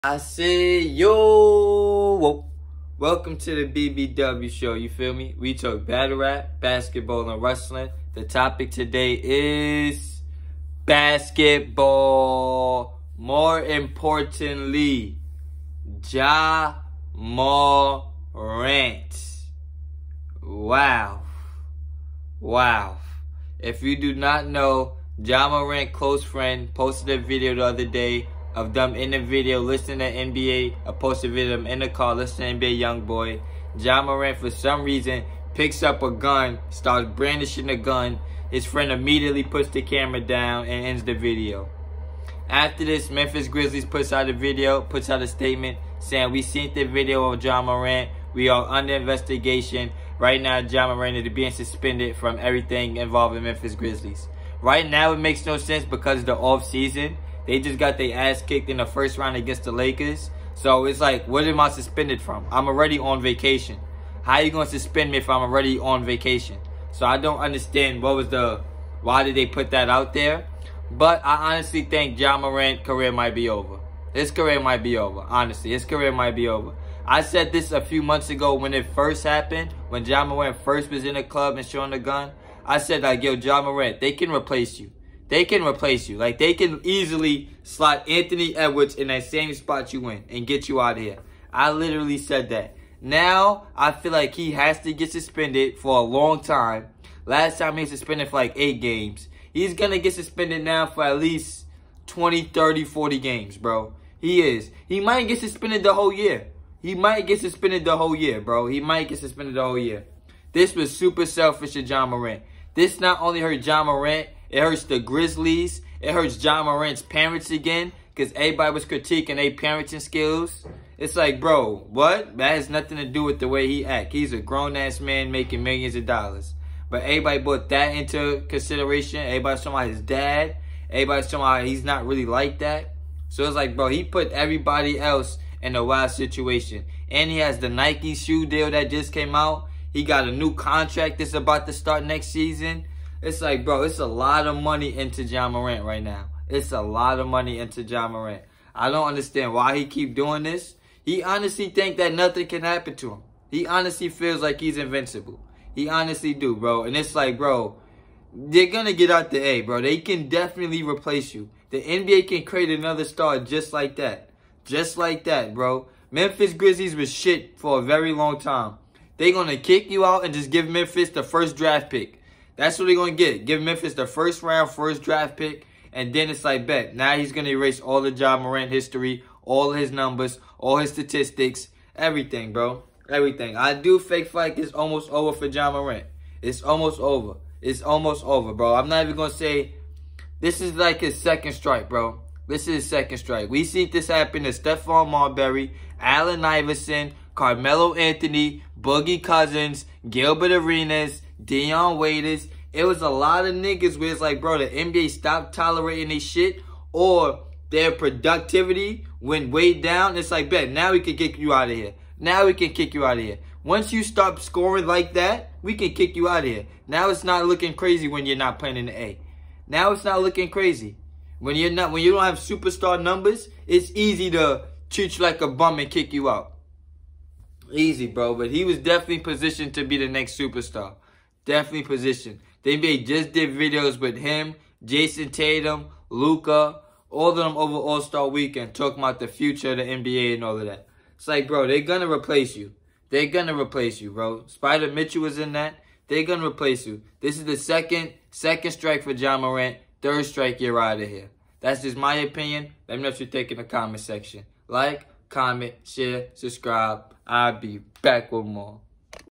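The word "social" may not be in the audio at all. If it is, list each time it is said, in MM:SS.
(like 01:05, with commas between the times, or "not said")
not said.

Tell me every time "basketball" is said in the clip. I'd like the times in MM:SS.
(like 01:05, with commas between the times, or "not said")
00:06, 00:10.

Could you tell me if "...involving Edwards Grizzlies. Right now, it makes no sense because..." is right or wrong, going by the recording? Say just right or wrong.
wrong.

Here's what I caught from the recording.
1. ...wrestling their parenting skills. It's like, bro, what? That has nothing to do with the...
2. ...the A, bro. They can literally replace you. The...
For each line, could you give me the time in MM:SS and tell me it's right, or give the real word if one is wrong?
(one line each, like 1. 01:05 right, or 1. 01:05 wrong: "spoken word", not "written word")
1. 01:58 wrong: "critiquing", not "wrestling"
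2. 02:39 wrong: "definitely", not "literally".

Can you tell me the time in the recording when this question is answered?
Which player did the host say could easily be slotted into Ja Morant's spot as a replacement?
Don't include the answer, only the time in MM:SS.
01:28.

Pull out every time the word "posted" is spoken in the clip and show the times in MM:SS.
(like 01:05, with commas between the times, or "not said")
00:26, 00:30.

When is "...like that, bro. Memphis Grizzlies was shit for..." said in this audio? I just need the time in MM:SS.
02:44.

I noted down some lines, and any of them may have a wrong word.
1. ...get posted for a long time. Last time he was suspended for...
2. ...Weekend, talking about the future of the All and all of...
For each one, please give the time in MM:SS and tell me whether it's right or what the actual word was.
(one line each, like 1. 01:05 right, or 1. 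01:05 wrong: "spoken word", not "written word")
1. 01:34 wrong: "suspended", not "posted"
2. 03:58 wrong: "NBA", not "All".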